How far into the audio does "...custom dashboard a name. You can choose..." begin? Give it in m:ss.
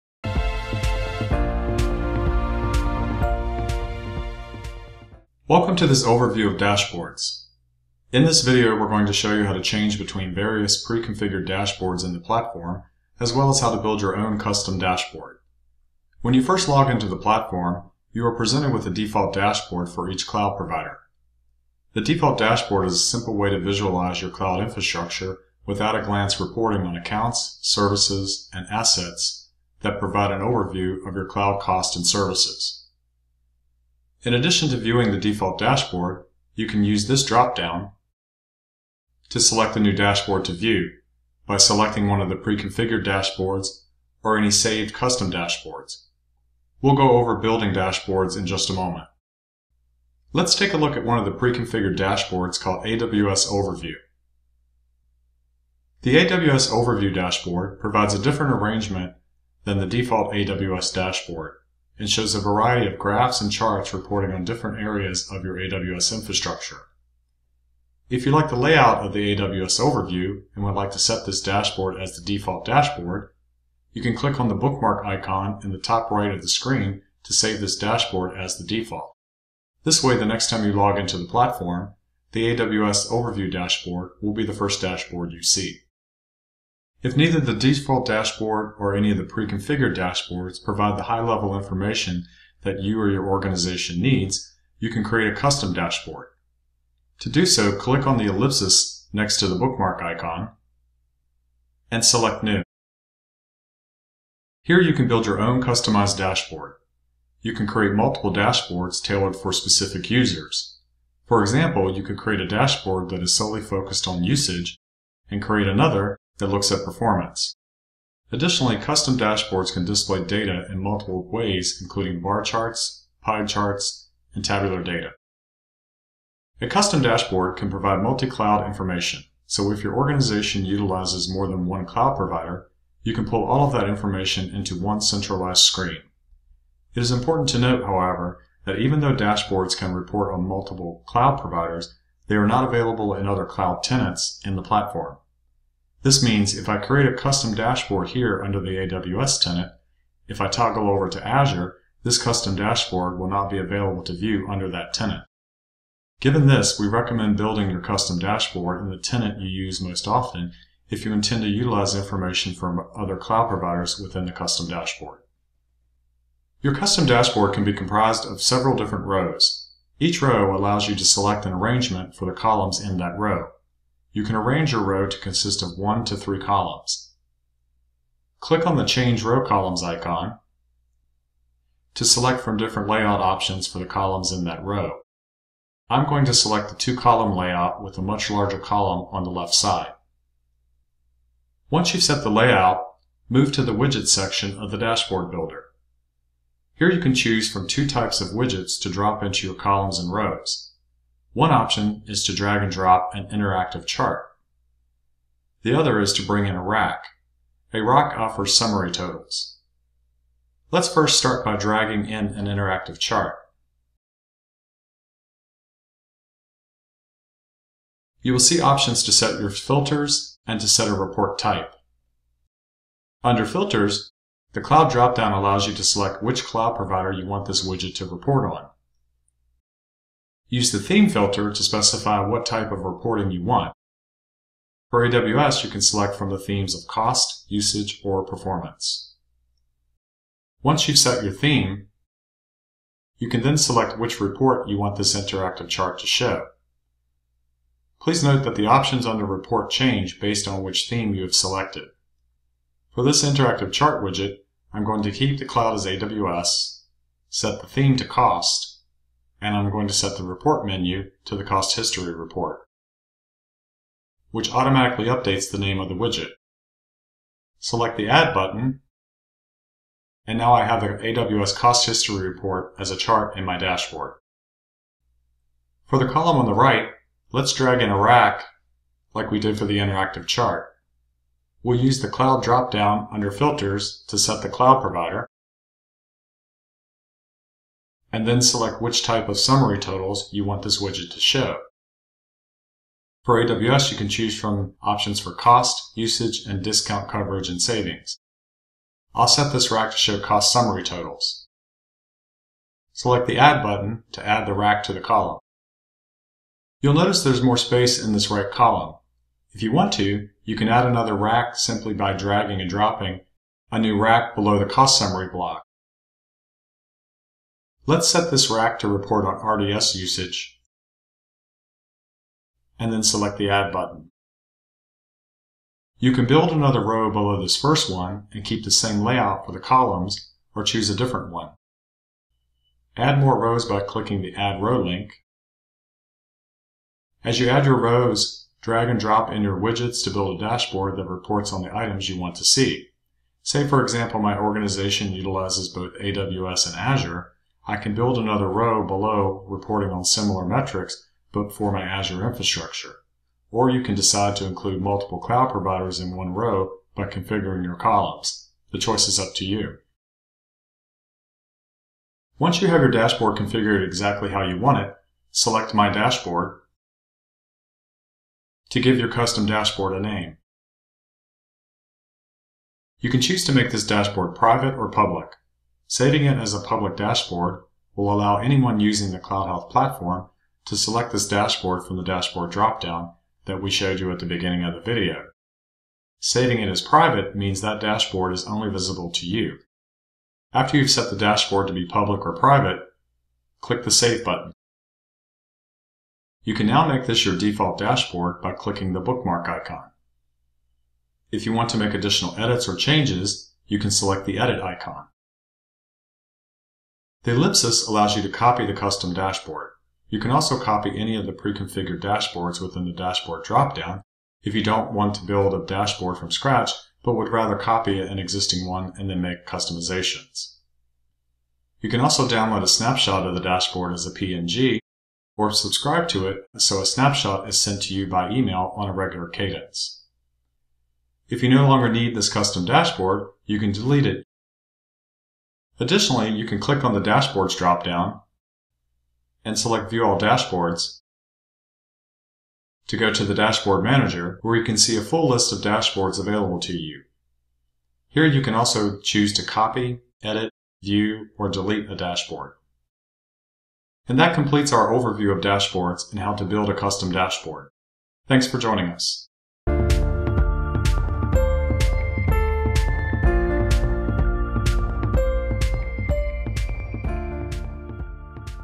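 6:09.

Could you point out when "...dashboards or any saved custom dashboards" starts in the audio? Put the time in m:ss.
0:43.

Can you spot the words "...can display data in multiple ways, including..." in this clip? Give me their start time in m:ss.
1:59.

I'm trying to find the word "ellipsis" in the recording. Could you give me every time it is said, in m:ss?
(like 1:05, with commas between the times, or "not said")
1:38, 6:47.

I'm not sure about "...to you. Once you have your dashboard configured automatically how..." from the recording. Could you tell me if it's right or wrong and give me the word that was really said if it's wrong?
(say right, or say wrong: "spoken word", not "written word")
wrong: "exactly", not "automatically".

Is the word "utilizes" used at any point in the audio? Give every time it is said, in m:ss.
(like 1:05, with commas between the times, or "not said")
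2:10, 2:41, 5:45.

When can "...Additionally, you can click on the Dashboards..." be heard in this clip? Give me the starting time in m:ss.
7:15.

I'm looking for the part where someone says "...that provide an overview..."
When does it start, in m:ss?
0:29.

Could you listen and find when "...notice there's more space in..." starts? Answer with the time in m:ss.
5:06.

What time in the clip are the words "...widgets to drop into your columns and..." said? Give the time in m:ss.
3:18.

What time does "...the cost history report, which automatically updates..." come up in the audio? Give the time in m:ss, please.
4:21.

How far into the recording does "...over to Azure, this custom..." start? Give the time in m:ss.
2:30.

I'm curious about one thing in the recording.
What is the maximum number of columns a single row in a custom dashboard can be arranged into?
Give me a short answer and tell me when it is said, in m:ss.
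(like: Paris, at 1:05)
3, at 2:56.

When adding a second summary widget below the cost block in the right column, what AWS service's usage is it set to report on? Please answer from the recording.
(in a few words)
RDS.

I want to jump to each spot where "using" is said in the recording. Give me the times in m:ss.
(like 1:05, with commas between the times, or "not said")
6:18.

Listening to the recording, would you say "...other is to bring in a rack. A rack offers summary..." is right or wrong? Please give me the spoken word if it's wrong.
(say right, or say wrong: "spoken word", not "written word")
right.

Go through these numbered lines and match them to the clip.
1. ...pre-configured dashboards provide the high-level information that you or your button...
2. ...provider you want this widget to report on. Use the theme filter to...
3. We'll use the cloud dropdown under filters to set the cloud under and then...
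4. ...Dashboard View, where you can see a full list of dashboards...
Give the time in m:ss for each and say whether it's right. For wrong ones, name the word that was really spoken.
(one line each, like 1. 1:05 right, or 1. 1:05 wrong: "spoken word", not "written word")
1. 1:29 wrong: "organization", not "button"
2. 3:46 right
3. 4:41 wrong: "provider", not "under"
4. 7:23 wrong: "Manager", not "View".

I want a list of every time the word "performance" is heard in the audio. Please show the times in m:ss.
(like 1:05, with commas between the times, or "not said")
1:56, 3:58.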